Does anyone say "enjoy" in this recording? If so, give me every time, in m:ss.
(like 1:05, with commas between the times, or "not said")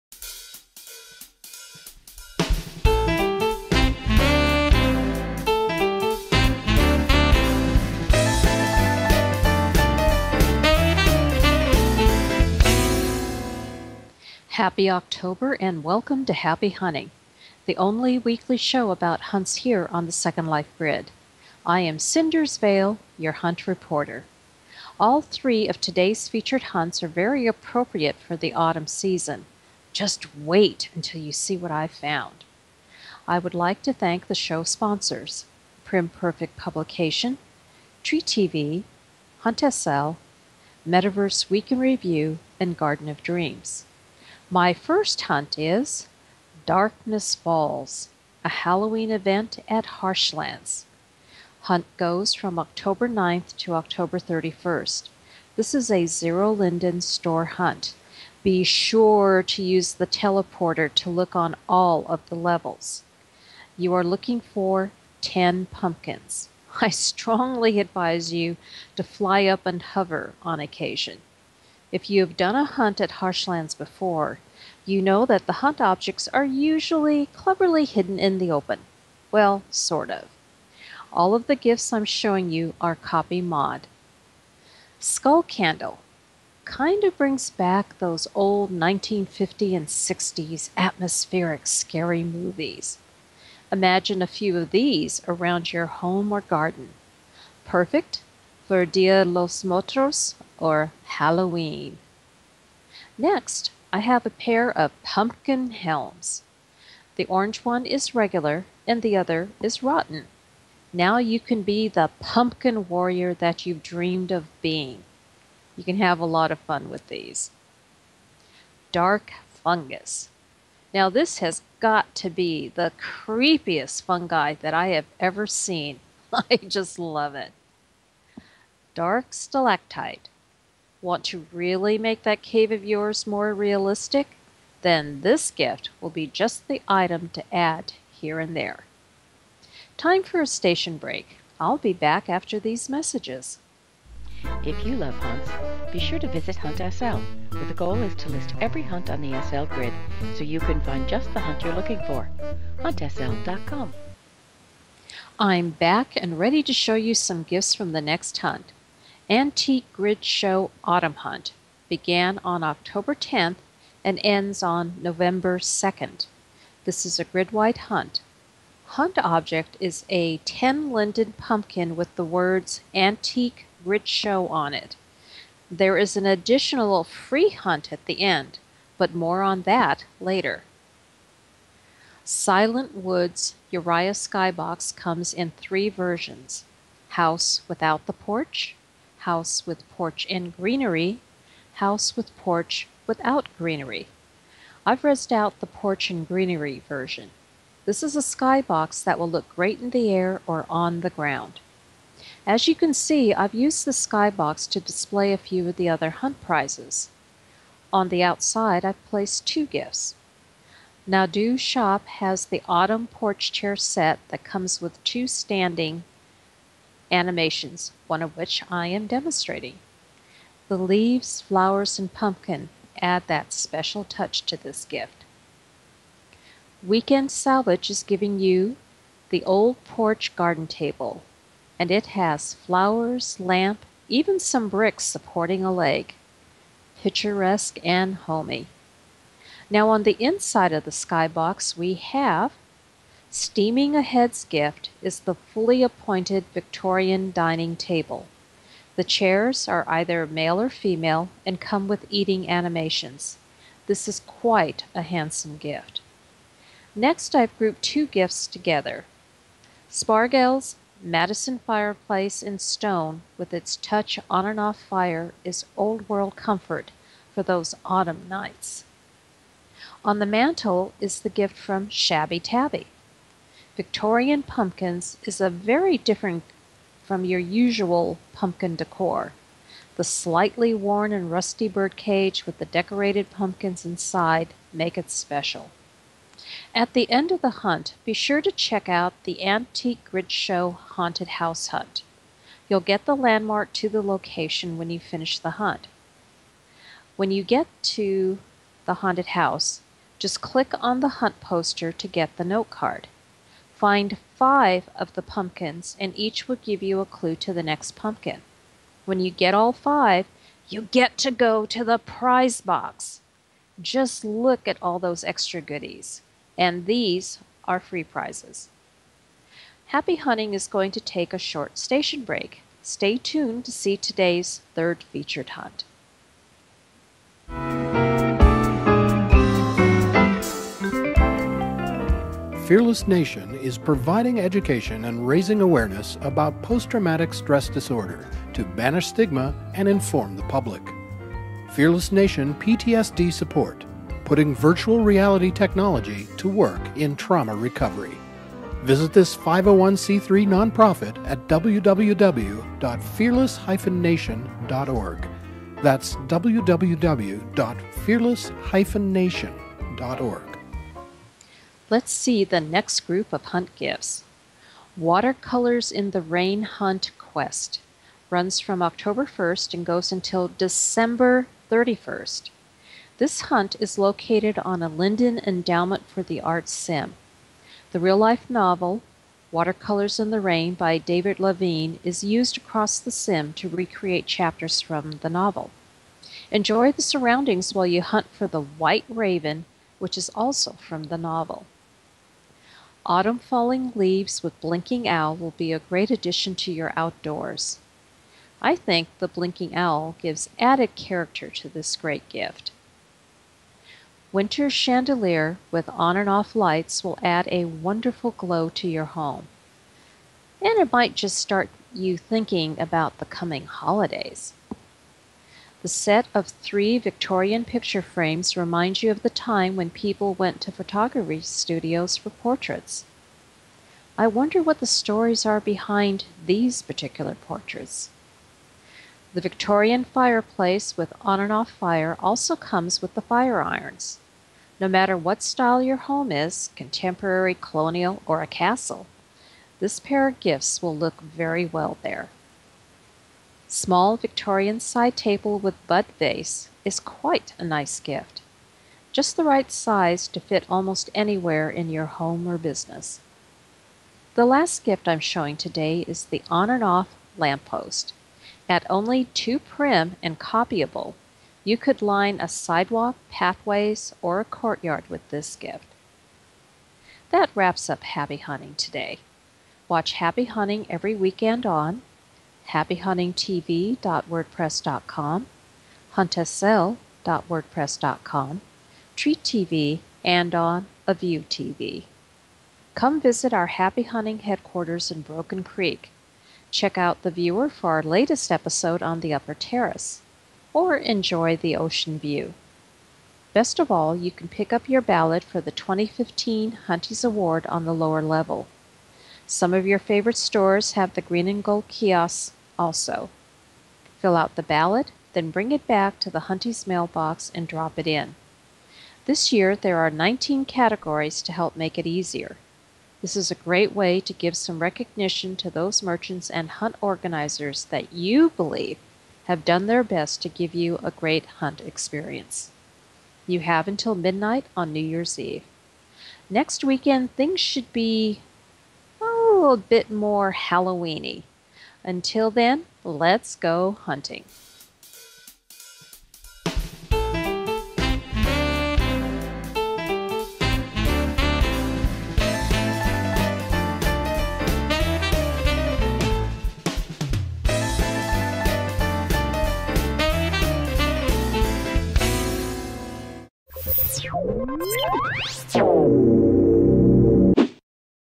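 6:26, 8:10.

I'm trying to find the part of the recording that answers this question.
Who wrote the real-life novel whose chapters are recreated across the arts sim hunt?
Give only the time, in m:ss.
6:20.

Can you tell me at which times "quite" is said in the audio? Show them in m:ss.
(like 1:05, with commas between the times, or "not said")
4:14, 7:26.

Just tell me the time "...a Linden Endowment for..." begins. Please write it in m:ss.
6:14.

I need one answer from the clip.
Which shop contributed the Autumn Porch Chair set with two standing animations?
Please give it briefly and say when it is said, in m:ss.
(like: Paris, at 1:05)
Nadu Shop, at 3:31.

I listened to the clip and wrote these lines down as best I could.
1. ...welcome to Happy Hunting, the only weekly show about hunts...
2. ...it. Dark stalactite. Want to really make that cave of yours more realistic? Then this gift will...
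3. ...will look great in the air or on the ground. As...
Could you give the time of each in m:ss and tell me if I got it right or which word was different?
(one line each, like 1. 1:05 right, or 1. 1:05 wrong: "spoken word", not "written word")
1. 0:15 right
2. 2:07 right
3. 3:19 right.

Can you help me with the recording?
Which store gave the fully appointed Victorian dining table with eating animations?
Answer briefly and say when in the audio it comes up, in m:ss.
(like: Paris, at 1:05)
Steaming Ahead, at 4:03.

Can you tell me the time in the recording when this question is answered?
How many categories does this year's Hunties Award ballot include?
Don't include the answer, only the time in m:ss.
8:30.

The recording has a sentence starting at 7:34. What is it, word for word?
The last gift I'm showing today is the on and off lamppost.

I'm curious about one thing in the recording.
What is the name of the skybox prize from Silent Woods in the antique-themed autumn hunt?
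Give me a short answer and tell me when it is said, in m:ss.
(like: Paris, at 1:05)
Uriah Skybox, at 3:03.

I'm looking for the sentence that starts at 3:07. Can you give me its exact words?
House without the porch, house with porch and greenery, house with porch without greenery.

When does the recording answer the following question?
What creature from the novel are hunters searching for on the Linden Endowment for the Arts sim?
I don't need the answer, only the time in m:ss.
6:28.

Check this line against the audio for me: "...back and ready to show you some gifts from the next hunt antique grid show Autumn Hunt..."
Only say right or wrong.
right.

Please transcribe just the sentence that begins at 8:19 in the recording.
Some of your favorite stores have the green and gold kiosks also.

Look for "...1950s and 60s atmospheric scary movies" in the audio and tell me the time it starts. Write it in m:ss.
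1:28.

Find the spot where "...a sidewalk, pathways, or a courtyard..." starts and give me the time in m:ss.
7:42.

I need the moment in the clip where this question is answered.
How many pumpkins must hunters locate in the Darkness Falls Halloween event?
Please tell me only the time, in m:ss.
1:05.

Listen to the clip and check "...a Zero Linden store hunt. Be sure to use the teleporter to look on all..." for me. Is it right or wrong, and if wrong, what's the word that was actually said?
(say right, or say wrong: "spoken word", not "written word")
right.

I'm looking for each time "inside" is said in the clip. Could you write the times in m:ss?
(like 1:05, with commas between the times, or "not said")
4:00, 4:43.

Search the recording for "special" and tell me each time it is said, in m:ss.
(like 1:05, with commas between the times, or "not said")
3:43, 4:45.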